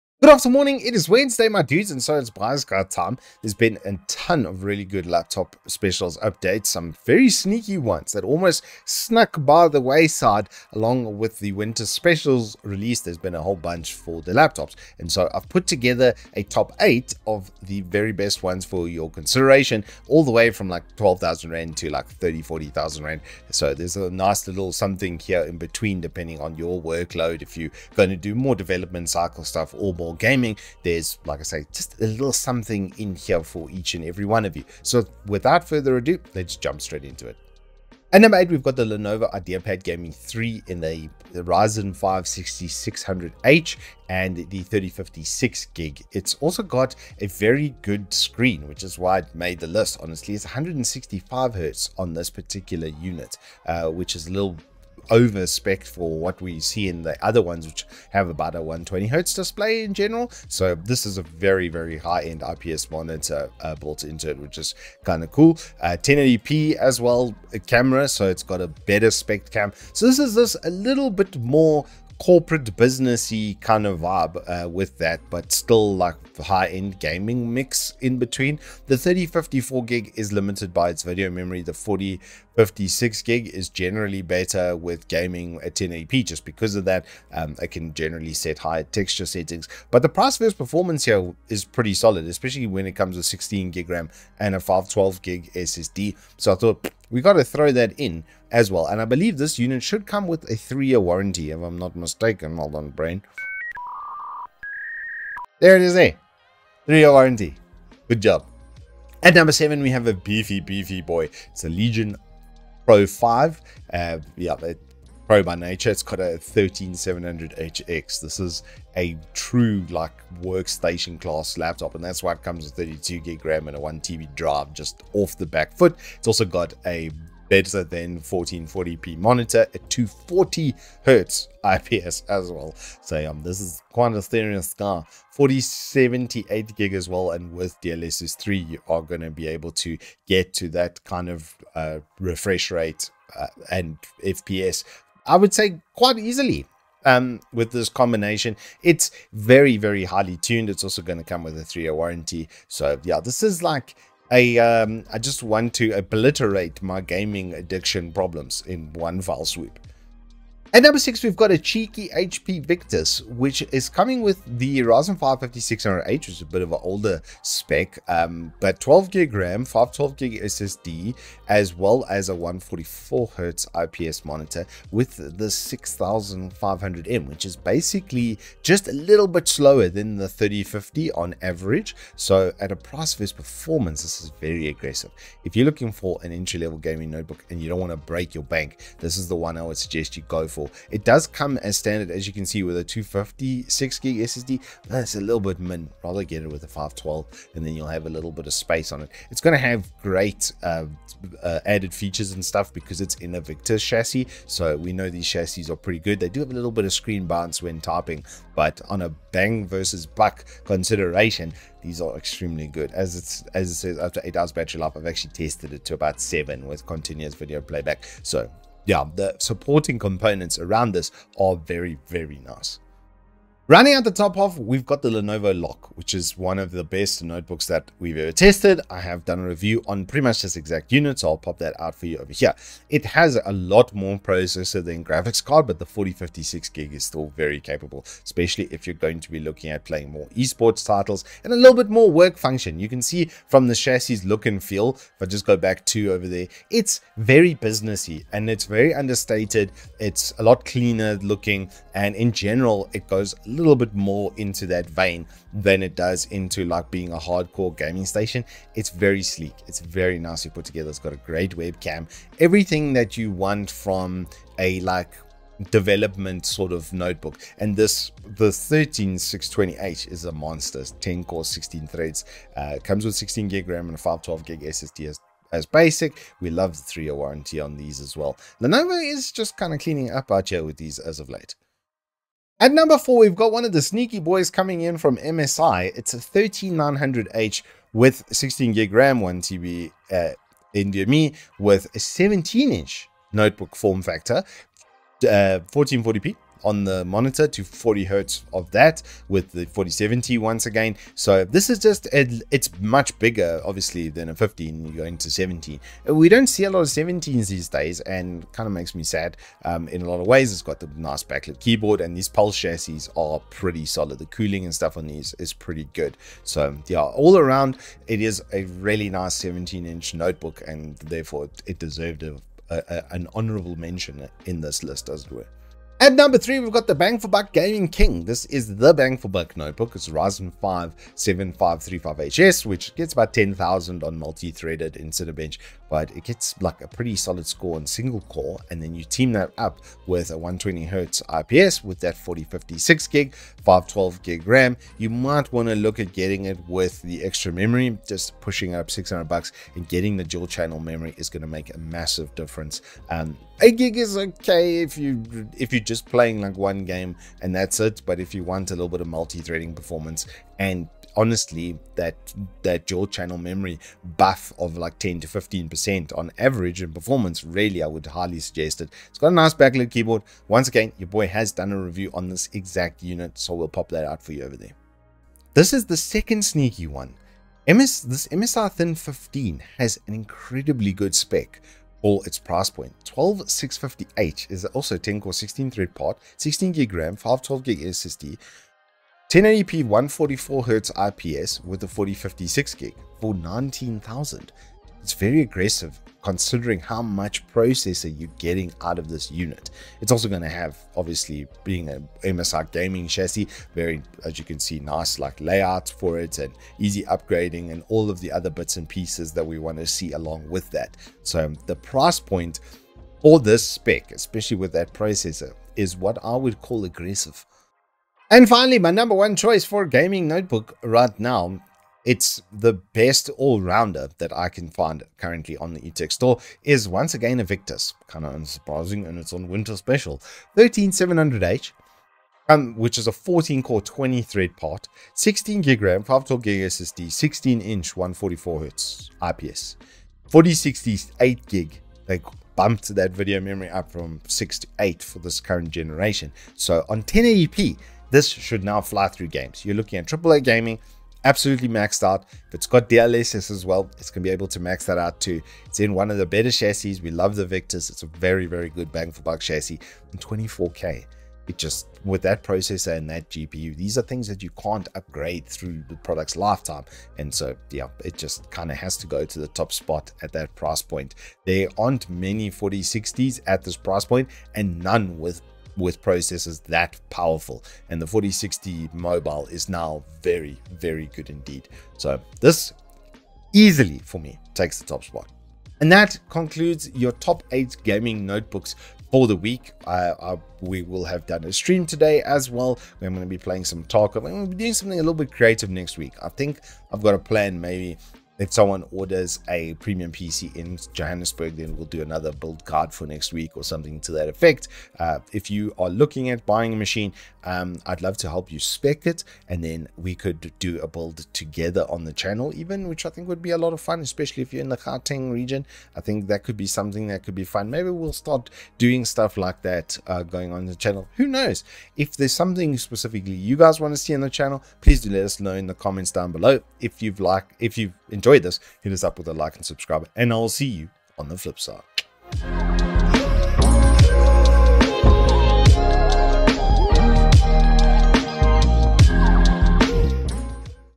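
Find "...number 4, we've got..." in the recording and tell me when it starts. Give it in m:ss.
4:42.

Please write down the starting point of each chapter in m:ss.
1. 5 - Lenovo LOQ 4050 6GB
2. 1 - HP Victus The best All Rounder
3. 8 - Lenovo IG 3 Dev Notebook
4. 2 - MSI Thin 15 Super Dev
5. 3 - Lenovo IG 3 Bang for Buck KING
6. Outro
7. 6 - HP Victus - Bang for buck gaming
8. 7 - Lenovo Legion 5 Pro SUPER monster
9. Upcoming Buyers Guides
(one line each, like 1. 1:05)
1. 3:43
2. 6:58
3. 0:38
4. 6:16
5. 5:25
6. 8:46
7. 2:41
8. 1:49
9. 8:06.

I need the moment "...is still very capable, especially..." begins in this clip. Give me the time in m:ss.
3:56.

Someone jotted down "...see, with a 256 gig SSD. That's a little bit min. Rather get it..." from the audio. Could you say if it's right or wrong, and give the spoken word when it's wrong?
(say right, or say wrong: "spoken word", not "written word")
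right.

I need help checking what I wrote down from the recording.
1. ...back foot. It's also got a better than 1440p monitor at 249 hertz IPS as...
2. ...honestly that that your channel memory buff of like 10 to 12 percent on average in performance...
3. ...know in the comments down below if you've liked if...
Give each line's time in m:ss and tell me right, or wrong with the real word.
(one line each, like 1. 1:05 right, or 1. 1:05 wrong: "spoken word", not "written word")
1. 2:05 wrong: "240", not "249"
2. 6:01 wrong: "15", not "12"
3. 8:45 right.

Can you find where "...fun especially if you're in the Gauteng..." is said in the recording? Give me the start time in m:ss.
8:33.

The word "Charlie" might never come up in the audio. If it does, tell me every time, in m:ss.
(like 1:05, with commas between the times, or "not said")
not said.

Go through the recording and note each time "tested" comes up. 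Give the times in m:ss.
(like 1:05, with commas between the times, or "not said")
3:35, 3:48.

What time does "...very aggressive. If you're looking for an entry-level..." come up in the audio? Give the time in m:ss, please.
3:04.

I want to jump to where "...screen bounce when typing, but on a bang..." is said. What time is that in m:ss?
3:26.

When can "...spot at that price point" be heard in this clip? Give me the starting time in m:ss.
7:49.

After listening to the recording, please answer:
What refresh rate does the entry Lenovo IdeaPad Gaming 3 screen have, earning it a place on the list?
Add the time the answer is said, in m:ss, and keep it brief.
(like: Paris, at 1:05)
165 Hz, at 0:50.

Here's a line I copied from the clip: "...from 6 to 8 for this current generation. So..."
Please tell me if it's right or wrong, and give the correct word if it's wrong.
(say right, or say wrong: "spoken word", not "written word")
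right.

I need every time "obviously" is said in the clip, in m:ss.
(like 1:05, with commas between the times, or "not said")
5:03, 6:40.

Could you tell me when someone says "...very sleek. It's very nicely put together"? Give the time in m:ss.
4:18.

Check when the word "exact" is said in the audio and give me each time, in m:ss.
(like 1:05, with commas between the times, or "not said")
3:50, 6:12.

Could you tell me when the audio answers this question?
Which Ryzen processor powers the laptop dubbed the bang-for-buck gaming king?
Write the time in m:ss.
5:30.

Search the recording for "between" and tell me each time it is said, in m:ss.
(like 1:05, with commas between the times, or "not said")
0:25, 1:18.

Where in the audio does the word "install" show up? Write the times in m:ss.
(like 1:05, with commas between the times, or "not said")
not said.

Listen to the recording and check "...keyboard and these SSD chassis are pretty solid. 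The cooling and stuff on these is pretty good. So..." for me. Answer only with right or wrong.
wrong.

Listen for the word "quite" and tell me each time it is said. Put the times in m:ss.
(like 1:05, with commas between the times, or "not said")
2:13, 2:25.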